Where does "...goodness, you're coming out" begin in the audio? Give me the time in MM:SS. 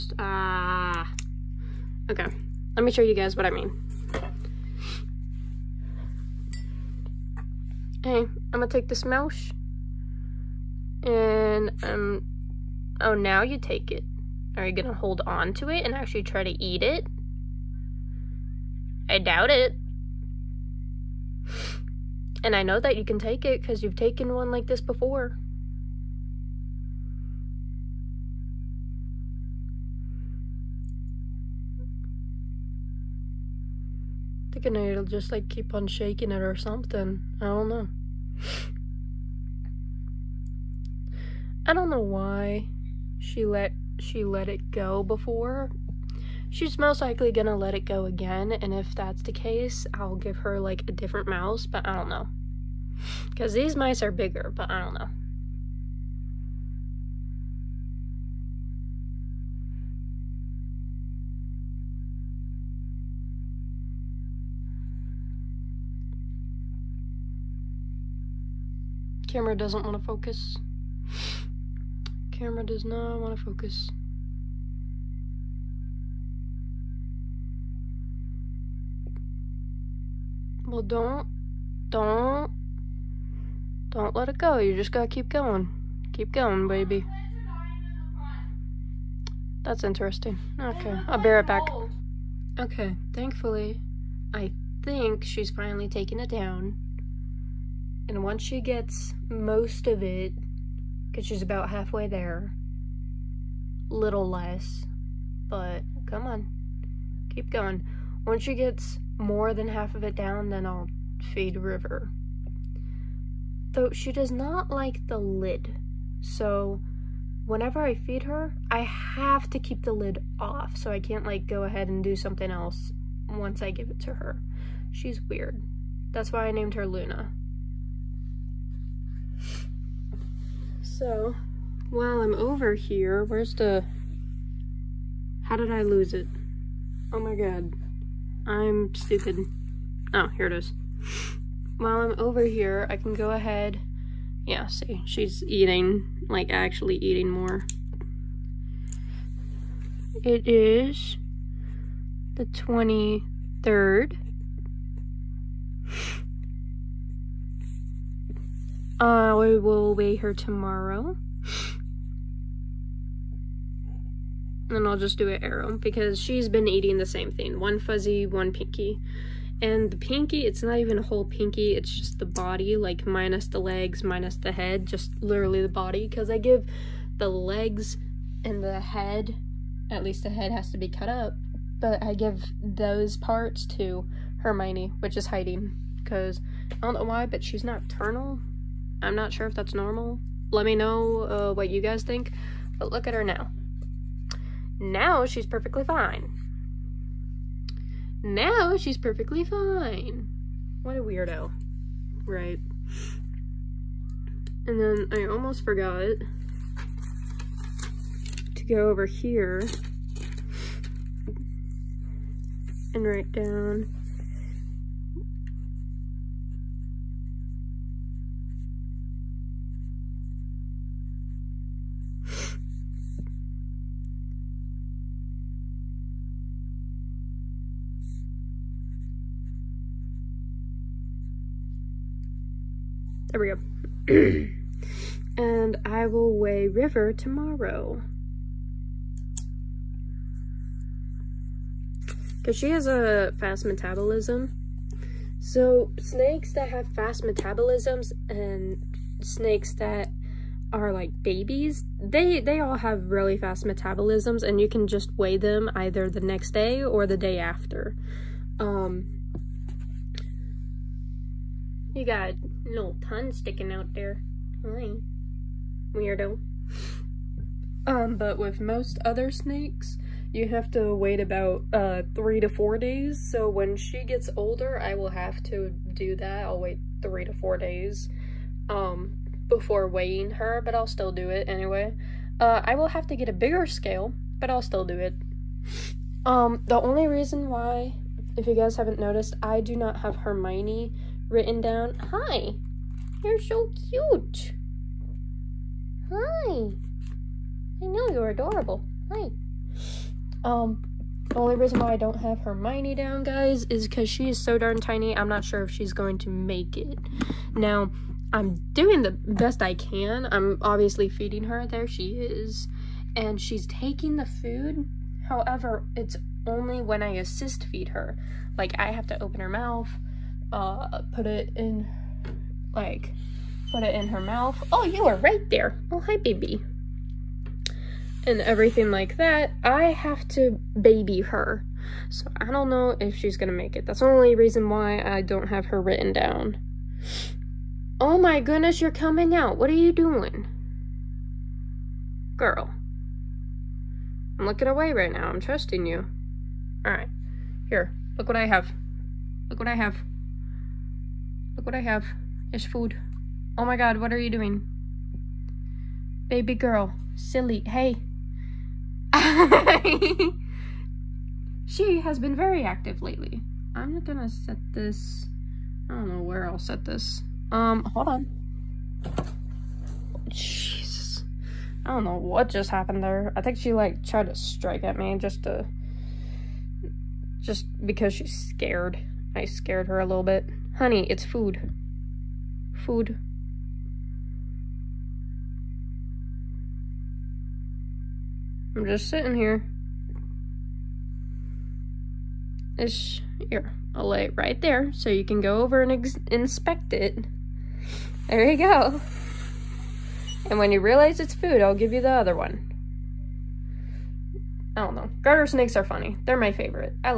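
05:38.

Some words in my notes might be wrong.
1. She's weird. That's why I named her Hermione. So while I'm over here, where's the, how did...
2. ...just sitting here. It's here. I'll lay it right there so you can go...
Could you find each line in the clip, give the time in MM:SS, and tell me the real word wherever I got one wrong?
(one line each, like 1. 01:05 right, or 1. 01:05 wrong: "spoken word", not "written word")
1. 02:04 wrong: "Luna", not "Hermione"
2. 06:28 right.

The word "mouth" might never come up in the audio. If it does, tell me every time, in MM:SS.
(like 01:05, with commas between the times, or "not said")
05:19, 05:24.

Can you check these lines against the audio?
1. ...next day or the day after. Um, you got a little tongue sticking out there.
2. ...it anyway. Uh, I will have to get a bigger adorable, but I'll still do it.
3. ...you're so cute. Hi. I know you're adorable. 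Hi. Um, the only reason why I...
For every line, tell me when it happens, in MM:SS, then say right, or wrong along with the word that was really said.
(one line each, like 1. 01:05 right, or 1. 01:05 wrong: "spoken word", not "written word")
1. 04:16 right
2. 04:41 wrong: "scale", not "adorable"
3. 04:53 right.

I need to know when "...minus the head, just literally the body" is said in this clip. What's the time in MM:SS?
02:54.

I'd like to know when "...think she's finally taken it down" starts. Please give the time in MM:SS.
01:34.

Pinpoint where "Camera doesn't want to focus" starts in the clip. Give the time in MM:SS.
01:09.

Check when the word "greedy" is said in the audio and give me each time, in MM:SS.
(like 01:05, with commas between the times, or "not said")
not said.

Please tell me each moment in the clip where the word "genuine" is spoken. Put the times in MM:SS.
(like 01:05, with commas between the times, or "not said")
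not said.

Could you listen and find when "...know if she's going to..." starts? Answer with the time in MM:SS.
05:32.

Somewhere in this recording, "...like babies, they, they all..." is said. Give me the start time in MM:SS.
04:10.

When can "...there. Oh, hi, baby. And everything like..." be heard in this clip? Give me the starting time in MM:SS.
05:25.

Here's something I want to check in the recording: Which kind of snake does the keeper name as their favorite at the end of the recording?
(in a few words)
Garter snakes.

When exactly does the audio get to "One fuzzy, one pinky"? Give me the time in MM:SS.
02:47.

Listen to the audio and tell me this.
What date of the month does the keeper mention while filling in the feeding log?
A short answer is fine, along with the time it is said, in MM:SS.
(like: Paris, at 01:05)
23rd, at 02:32.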